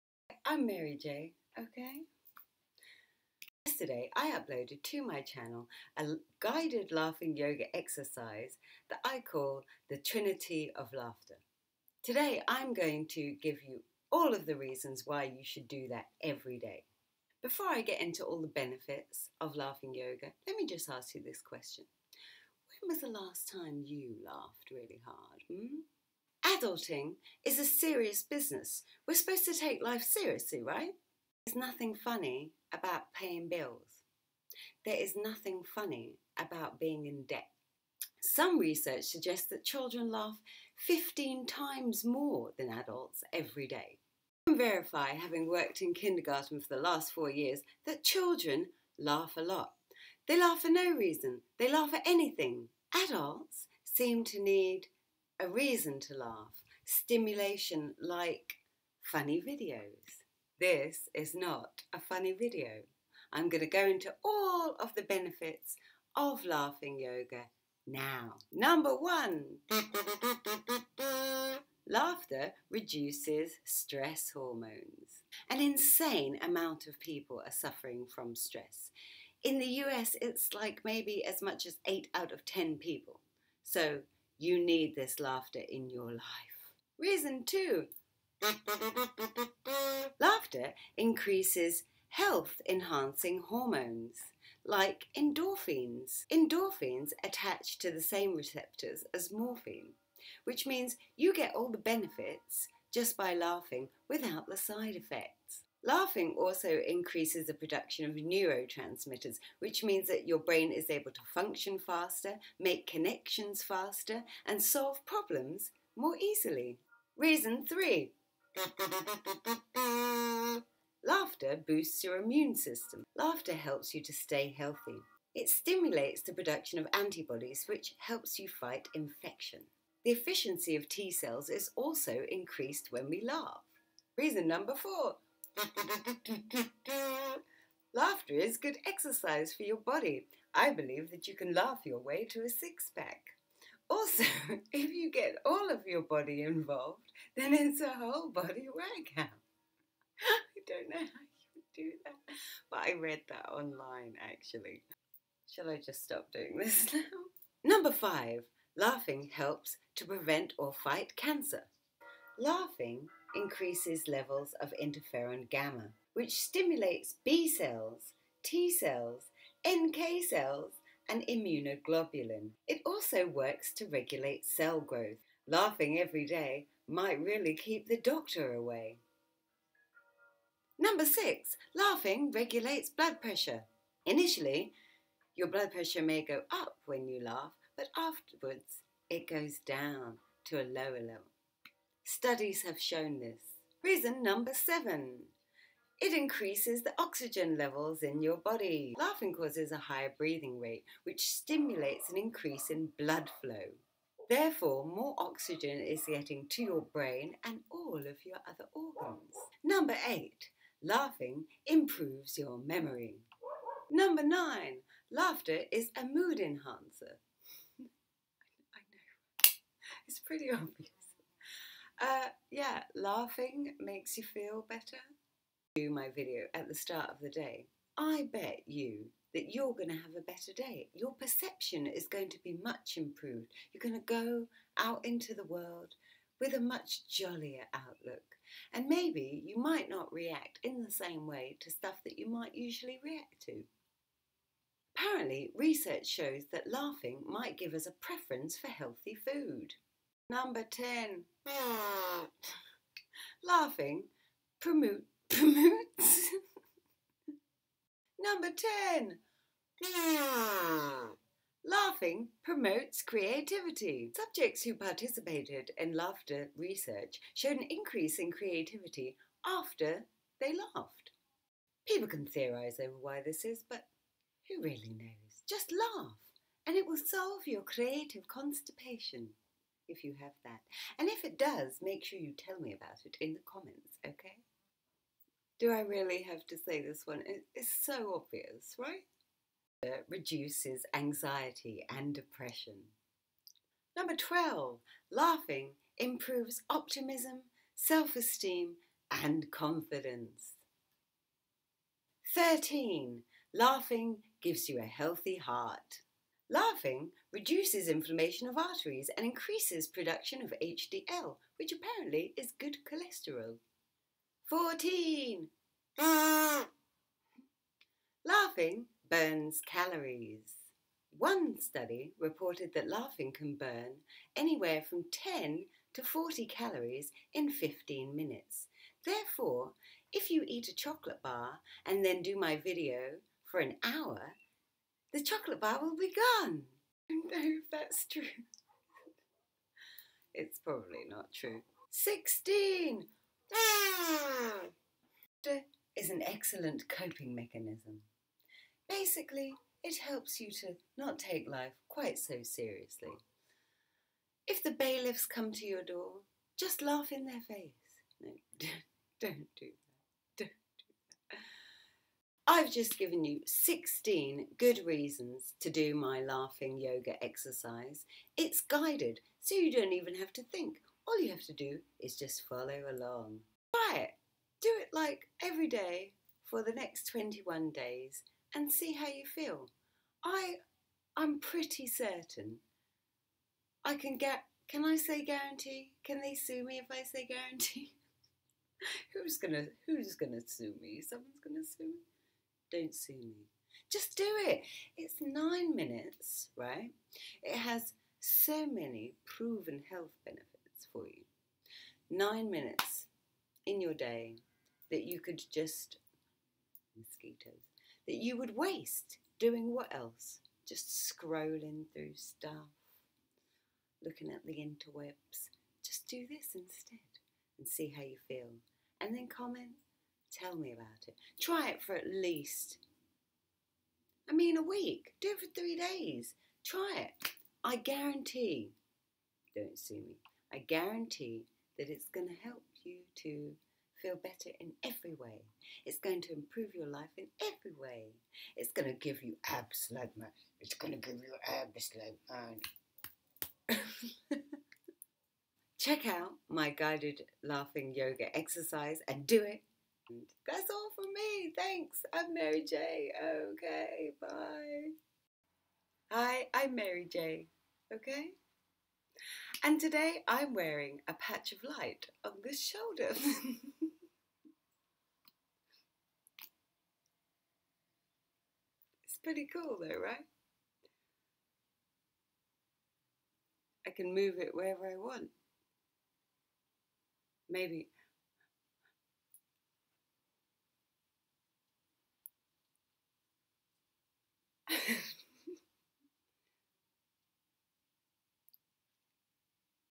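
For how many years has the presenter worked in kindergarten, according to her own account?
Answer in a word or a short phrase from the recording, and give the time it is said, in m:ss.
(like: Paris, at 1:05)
4, at 0:47.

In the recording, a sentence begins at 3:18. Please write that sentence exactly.
Laughing causes a higher breathing rate, which stimulates an increase in blood flow.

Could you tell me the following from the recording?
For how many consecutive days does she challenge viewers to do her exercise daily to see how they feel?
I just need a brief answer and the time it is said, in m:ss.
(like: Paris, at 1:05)
21, at 6:17.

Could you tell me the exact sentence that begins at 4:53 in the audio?
Number 12, laughing improves optimism, self esteem, and confidence.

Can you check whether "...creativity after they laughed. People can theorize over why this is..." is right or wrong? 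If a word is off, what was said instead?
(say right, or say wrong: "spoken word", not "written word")
right.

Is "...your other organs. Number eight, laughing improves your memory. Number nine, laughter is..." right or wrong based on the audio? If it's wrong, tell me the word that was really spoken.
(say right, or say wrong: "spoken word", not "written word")
right.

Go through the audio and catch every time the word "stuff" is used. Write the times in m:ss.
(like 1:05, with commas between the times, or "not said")
4:01, 6:52.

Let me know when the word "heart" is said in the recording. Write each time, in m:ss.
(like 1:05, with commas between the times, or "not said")
5:05.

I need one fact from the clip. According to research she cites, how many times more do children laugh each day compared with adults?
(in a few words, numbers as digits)
15.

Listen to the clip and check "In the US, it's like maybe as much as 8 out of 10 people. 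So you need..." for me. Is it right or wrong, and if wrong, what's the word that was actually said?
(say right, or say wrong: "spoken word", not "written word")
right.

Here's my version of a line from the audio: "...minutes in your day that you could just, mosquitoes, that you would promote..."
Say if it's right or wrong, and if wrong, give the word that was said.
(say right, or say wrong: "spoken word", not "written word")
wrong: "waste", not "promote".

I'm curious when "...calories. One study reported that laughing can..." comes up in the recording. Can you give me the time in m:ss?
5:19.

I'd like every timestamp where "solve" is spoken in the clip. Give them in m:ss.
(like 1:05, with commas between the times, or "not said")
1:54, 4:36.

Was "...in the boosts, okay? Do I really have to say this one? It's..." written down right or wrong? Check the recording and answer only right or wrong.
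wrong.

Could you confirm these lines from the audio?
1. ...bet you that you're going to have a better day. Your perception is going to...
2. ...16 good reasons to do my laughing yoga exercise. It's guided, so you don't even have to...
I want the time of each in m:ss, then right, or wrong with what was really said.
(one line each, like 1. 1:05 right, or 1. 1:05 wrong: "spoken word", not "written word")
1. 3:48 right
2. 6:03 right.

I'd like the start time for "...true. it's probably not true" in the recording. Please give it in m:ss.
5:38.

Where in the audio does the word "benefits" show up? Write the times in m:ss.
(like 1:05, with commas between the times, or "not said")
0:18, 1:05, 1:41, 6:40.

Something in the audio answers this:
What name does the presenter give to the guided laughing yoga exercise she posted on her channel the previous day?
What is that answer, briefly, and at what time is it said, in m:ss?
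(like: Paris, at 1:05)
Trinity of Laughter, at 0:09.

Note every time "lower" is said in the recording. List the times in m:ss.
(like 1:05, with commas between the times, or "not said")
3:10.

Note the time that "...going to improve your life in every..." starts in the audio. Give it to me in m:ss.
7:15.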